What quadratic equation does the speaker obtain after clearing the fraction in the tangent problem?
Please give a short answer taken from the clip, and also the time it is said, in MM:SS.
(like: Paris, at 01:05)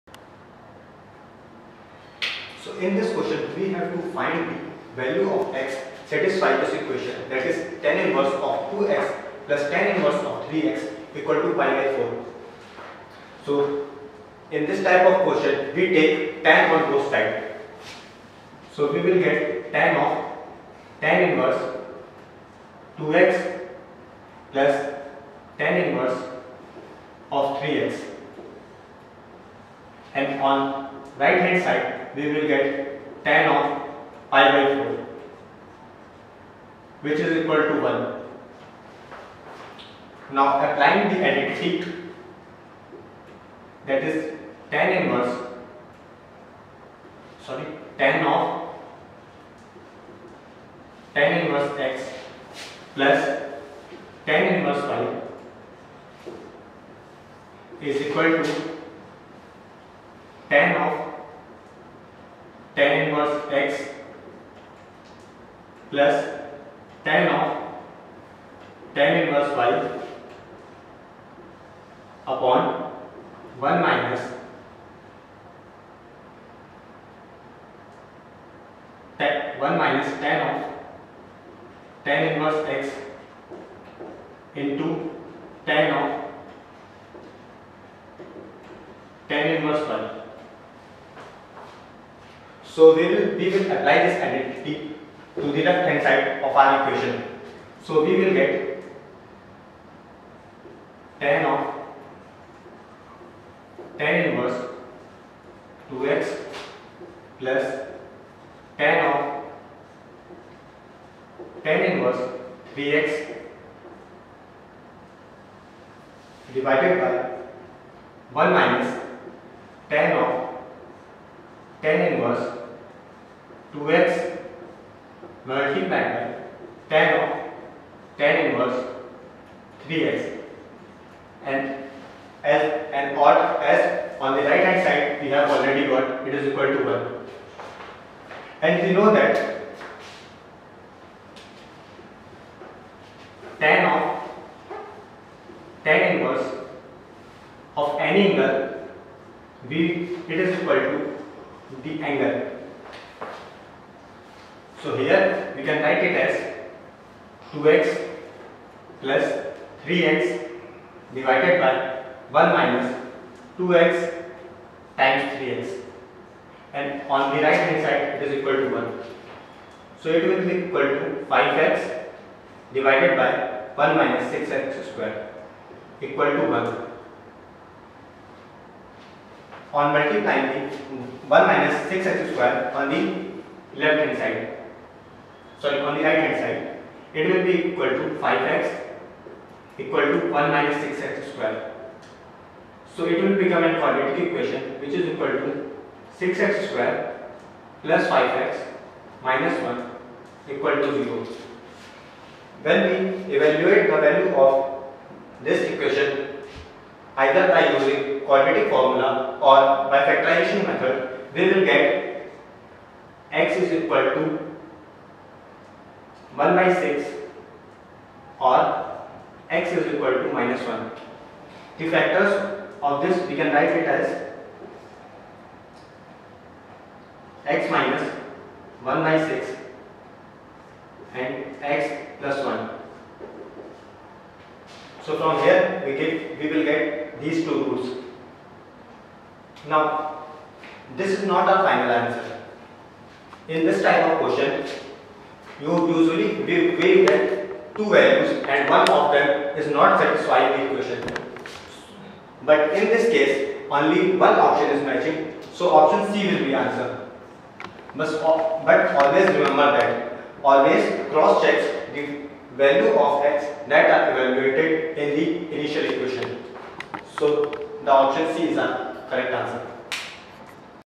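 6x^2 + 5x - 1 = 0, at 03:16.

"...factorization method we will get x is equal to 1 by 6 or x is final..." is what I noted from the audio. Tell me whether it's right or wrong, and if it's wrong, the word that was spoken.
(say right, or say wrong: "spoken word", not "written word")
wrong: "equal", not "final".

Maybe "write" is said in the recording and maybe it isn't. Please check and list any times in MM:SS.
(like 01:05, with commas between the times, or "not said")
02:35, 03:43.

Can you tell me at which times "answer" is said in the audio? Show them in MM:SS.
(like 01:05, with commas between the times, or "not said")
04:02, 04:16, 04:29.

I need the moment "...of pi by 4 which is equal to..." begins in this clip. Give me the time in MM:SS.
00:33.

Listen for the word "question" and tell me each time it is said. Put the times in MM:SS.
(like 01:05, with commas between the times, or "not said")
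00:03, 00:15, 04:04.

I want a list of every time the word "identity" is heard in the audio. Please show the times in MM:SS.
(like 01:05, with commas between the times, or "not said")
00:41, 01:34.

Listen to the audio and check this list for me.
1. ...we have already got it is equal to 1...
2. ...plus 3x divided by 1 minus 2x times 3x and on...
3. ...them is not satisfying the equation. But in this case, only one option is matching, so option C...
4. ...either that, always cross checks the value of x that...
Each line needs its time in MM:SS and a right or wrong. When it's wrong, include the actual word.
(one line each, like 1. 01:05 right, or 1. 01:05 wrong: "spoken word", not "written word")
1. 02:15 right
2. 02:39 right
3. 04:09 right
4. 04:19 wrong: "remember", not "either".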